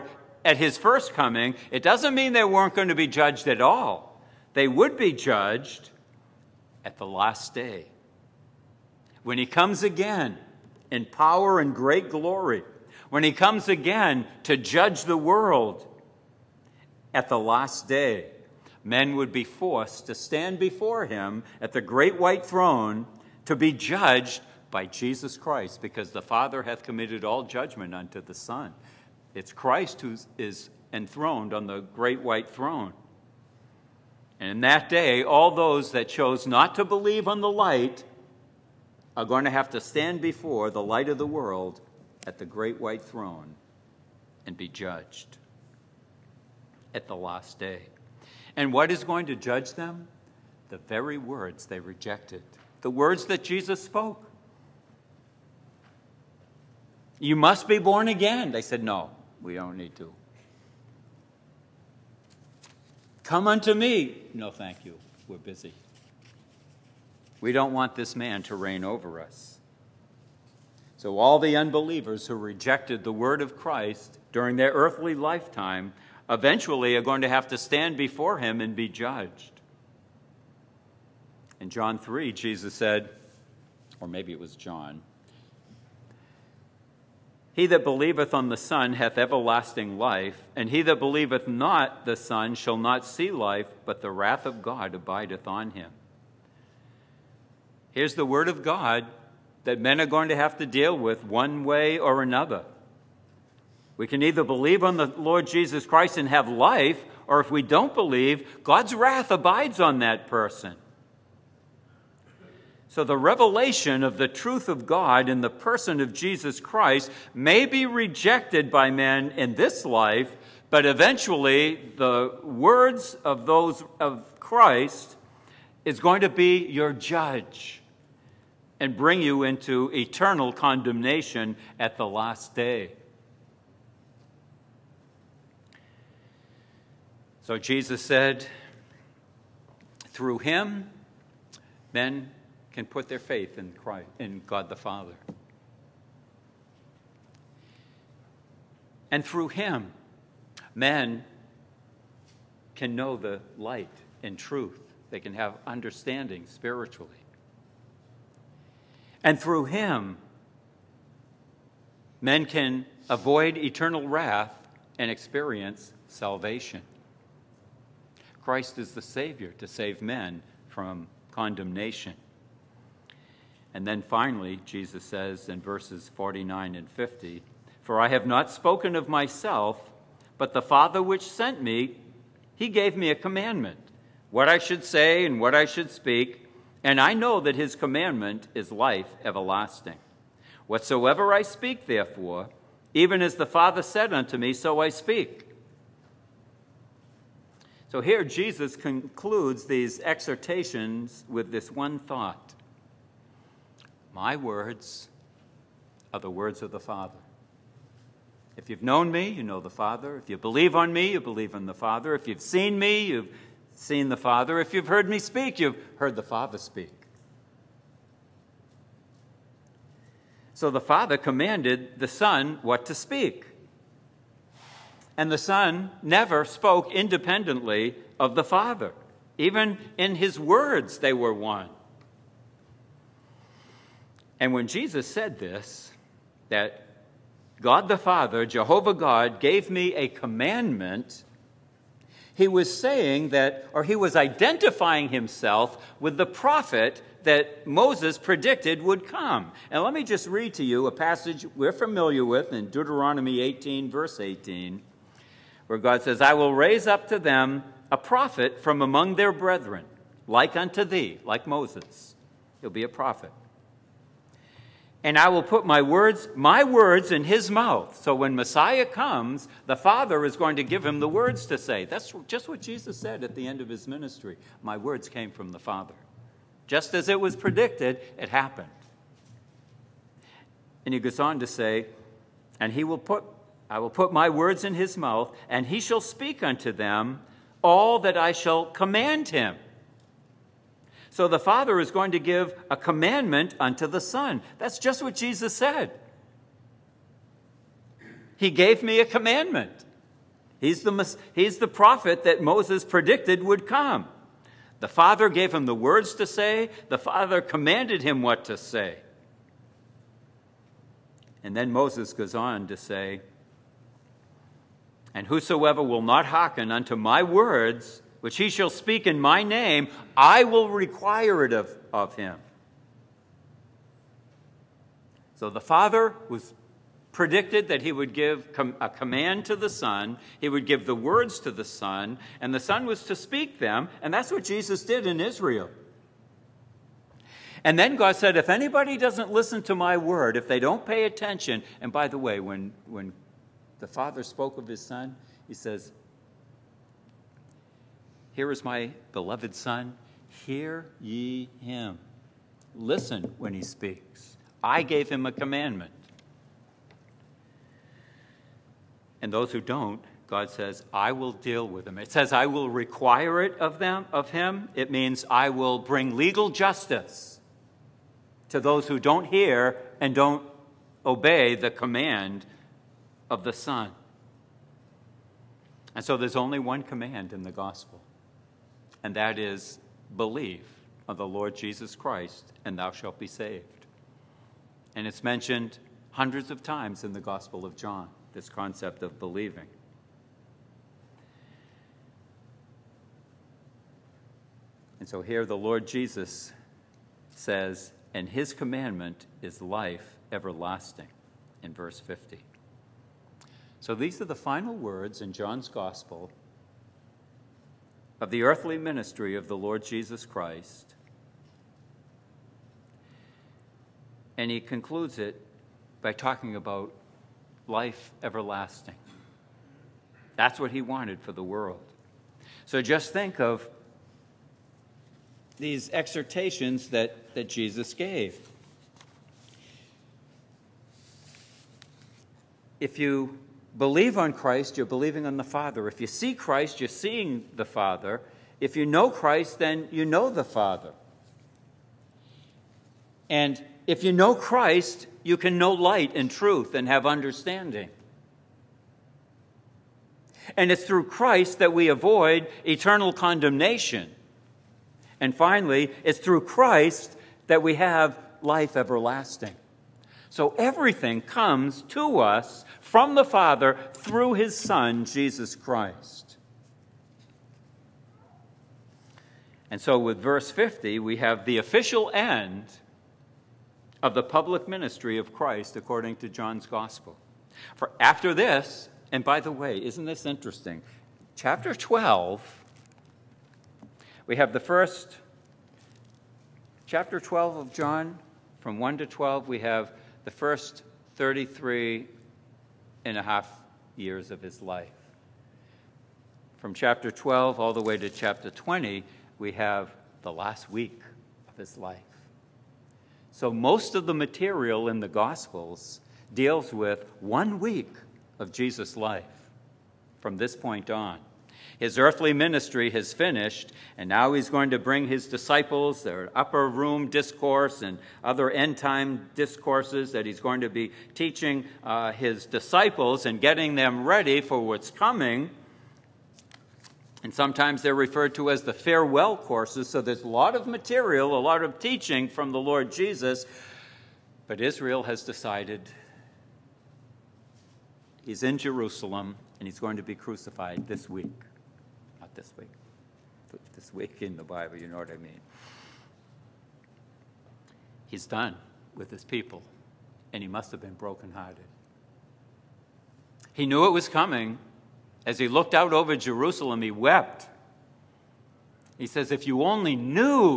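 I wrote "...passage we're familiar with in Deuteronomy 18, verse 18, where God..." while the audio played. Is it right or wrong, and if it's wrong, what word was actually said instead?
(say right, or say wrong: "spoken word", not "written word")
right.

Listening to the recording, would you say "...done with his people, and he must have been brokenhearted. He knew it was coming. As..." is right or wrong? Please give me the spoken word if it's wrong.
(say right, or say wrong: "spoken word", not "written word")
right.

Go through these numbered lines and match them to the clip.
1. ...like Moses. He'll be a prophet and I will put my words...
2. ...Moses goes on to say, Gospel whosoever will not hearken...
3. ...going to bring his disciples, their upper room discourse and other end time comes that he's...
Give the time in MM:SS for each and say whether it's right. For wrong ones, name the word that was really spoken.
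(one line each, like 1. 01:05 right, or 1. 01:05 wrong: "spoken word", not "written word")
1. 04:21 right
2. 05:11 wrong: "And", not "Gospel"
3. 08:34 wrong: "discourses", not "comes".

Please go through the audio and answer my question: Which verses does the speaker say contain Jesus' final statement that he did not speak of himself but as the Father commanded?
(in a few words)
Verses 49 and 50.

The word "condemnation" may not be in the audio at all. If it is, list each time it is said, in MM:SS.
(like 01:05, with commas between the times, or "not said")
02:10, 02:51, 07:33.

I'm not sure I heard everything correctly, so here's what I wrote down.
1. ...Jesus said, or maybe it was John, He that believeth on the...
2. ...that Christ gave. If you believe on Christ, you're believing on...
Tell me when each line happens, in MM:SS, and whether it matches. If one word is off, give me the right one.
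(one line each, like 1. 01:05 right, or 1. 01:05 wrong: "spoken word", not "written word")
1. 01:22 right
2. 07:07 wrong: "Jesus", not "Christ".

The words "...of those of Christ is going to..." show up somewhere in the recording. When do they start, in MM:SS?
02:03.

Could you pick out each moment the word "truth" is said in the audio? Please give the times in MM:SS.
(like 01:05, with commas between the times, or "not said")
01:54, 02:34, 07:26.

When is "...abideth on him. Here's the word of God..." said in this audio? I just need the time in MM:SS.
01:34.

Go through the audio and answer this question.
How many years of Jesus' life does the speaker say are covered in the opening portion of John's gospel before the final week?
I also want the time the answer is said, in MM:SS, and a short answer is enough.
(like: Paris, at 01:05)
33 and a half, at 08:11.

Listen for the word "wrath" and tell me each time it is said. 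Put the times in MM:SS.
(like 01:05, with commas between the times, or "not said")
01:34, 01:48, 02:44.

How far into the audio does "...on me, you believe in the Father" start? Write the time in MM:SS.
03:30.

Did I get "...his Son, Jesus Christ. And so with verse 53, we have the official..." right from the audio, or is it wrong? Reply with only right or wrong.
wrong.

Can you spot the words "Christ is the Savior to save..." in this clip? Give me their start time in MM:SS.
02:48.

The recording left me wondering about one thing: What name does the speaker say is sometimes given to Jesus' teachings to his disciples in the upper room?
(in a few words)
Farewell courses.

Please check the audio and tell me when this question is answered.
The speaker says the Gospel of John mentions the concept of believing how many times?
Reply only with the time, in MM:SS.
06:26.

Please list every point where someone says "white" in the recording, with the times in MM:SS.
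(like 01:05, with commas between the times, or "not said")
00:22, 00:32, 00:42.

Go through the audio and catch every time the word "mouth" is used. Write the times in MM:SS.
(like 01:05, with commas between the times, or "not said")
04:27, 04:44.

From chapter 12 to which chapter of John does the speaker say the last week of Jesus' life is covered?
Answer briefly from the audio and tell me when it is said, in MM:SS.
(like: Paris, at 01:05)
Chapter 20, at 08:18.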